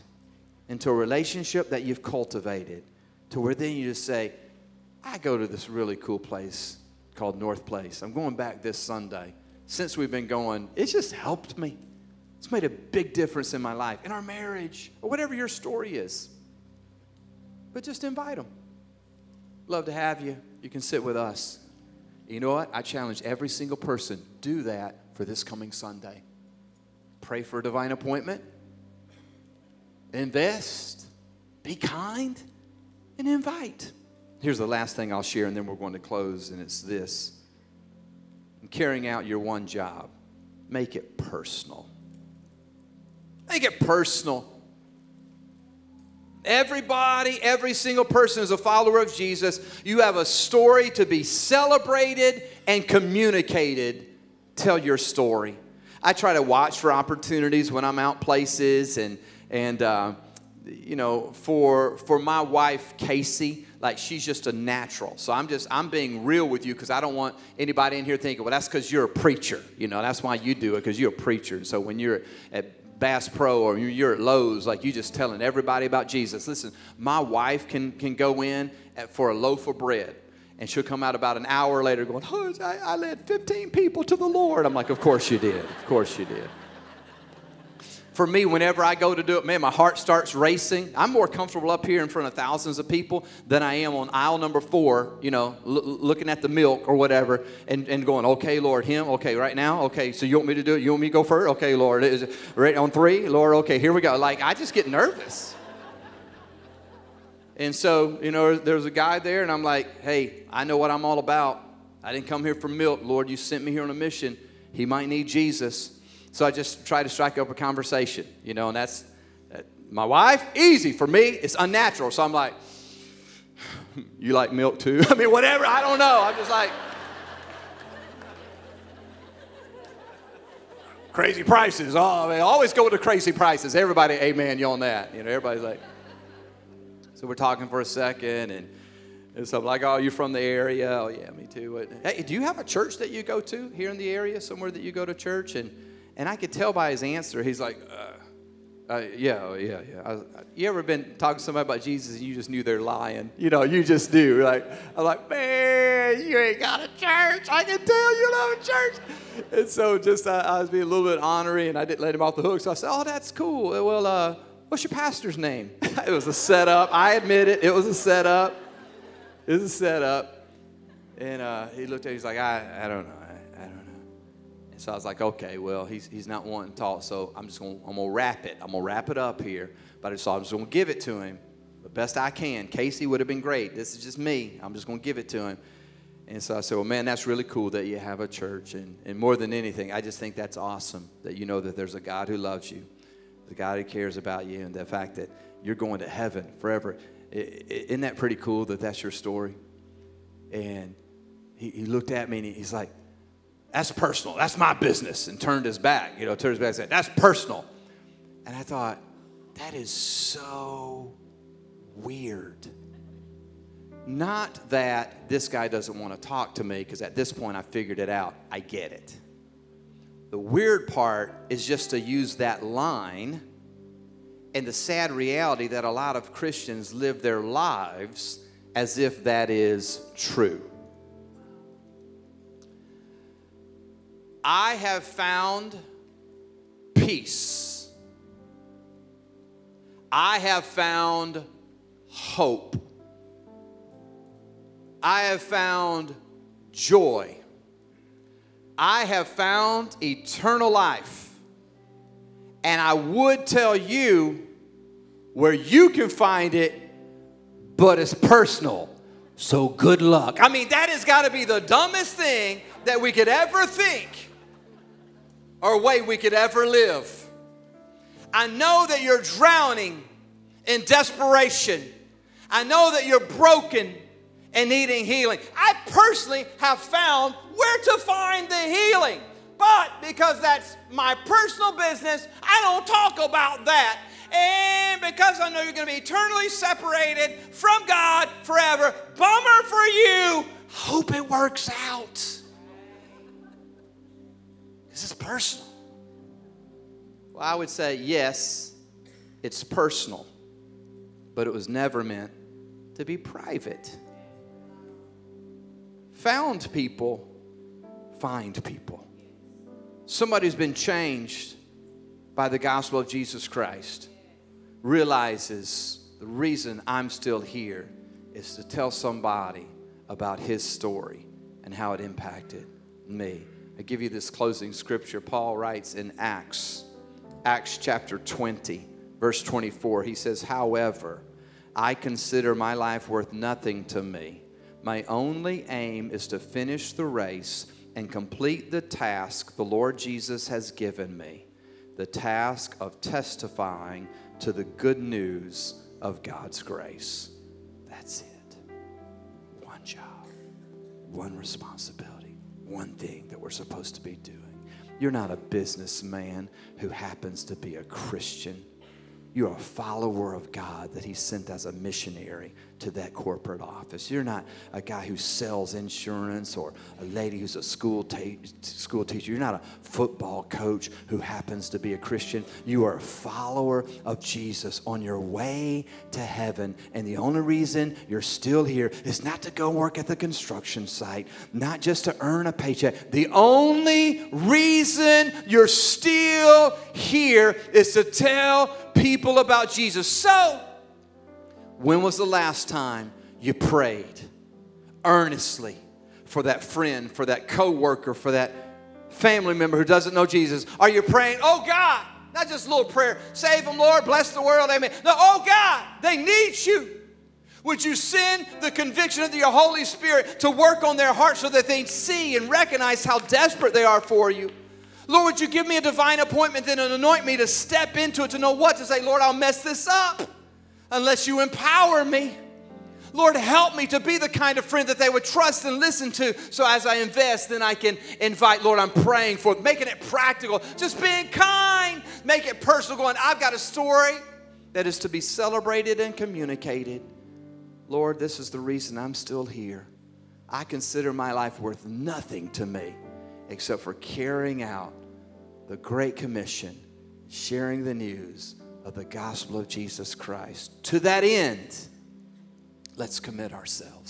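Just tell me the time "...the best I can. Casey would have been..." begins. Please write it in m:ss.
3:01.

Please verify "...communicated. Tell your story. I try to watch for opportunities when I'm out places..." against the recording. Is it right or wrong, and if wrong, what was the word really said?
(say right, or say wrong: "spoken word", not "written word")
right.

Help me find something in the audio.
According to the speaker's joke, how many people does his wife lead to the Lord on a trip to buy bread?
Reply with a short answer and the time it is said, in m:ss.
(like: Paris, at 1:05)
15, at 1:23.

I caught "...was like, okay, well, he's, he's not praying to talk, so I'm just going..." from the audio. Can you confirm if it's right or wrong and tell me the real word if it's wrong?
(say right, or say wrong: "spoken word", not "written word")
wrong: "wanting", not "praying".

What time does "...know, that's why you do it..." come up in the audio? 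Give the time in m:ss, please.
1:09.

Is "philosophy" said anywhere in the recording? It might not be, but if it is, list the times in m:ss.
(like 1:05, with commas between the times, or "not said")
not said.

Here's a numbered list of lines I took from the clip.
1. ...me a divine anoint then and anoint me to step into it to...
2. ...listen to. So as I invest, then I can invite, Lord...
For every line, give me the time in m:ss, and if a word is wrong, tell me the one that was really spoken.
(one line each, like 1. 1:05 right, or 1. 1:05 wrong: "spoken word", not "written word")
1. 6:55 wrong: "appointment", not "anoint"
2. 7:05 right.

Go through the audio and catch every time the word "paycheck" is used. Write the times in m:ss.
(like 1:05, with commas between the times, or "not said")
6:22.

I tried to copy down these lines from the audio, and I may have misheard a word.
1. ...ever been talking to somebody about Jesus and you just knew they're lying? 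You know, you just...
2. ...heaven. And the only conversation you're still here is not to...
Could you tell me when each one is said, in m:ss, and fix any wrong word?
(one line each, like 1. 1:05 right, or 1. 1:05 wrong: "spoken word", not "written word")
1. 2:30 right
2. 6:16 wrong: "reason", not "conversation".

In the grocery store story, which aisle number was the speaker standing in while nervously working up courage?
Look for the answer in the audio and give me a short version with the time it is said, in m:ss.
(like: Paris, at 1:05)
4, at 1:34.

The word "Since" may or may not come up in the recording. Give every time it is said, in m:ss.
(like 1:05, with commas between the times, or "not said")
0:09.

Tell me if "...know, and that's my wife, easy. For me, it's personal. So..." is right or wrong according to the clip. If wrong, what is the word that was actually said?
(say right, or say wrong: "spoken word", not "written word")
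wrong: "unnatural", not "personal".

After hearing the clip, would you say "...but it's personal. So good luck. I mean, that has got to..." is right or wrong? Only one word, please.
right.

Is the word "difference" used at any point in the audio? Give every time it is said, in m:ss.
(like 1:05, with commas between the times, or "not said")
0:13.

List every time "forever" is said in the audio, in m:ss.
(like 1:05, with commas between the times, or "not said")
3:16, 4:48.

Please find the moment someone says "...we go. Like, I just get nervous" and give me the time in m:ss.
1:43.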